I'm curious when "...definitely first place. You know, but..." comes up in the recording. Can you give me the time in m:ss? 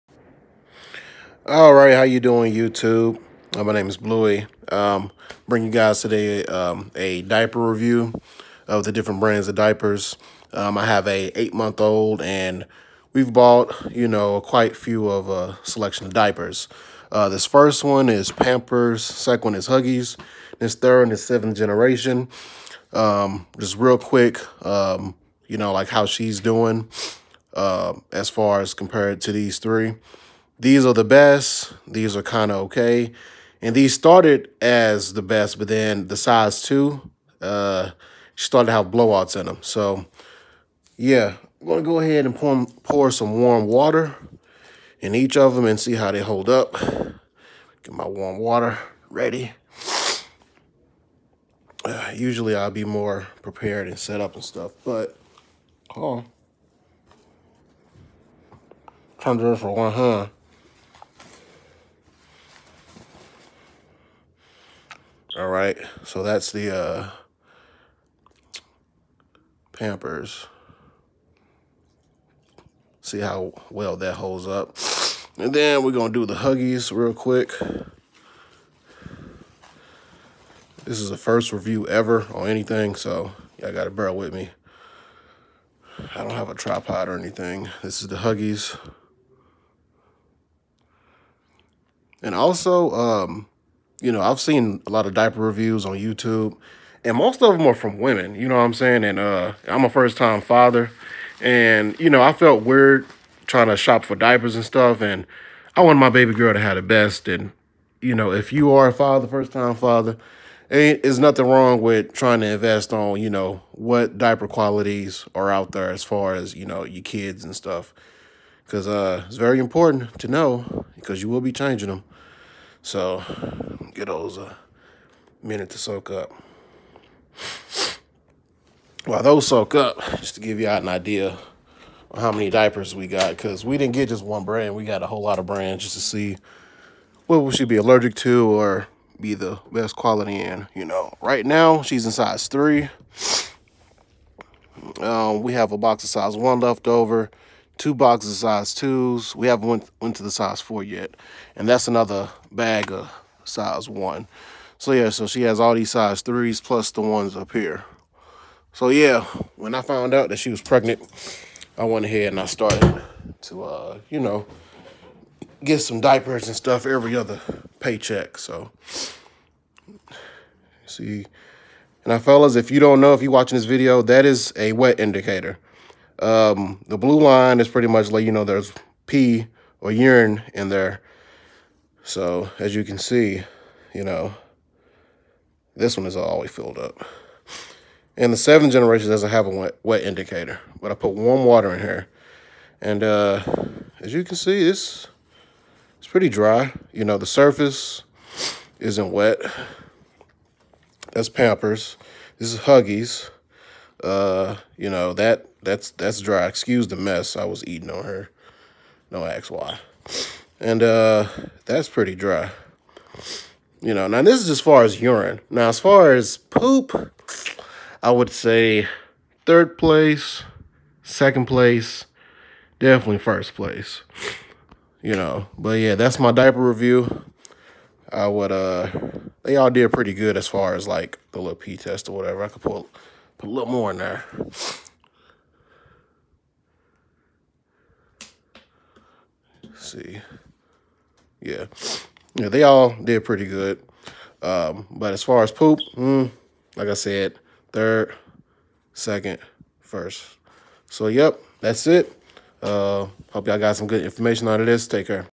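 3:42.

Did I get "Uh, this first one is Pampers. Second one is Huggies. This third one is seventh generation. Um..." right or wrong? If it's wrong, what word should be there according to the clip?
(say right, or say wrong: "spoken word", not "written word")
right.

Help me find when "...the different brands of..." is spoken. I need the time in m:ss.
0:08.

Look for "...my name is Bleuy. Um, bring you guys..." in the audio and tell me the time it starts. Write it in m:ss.
0:03.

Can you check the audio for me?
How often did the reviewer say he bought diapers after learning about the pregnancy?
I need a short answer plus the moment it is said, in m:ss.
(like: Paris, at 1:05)
Every other paycheck, at 2:46.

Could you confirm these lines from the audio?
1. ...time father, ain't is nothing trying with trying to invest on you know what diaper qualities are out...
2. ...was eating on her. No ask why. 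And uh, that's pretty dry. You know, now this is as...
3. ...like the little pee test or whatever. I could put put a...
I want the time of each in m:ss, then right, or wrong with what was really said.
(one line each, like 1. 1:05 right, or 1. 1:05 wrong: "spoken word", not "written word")
1. 1:49 wrong: "wrong", not "trying"
2. 3:27 right
3. 3:50 right.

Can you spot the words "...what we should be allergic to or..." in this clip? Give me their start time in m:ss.
2:17.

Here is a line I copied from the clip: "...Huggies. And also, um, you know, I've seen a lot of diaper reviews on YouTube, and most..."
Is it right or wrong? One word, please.
right.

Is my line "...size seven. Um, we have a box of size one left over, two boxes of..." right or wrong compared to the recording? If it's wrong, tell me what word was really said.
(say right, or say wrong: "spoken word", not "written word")
wrong: "three", not "seven".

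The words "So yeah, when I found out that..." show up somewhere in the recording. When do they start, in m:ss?
2:38.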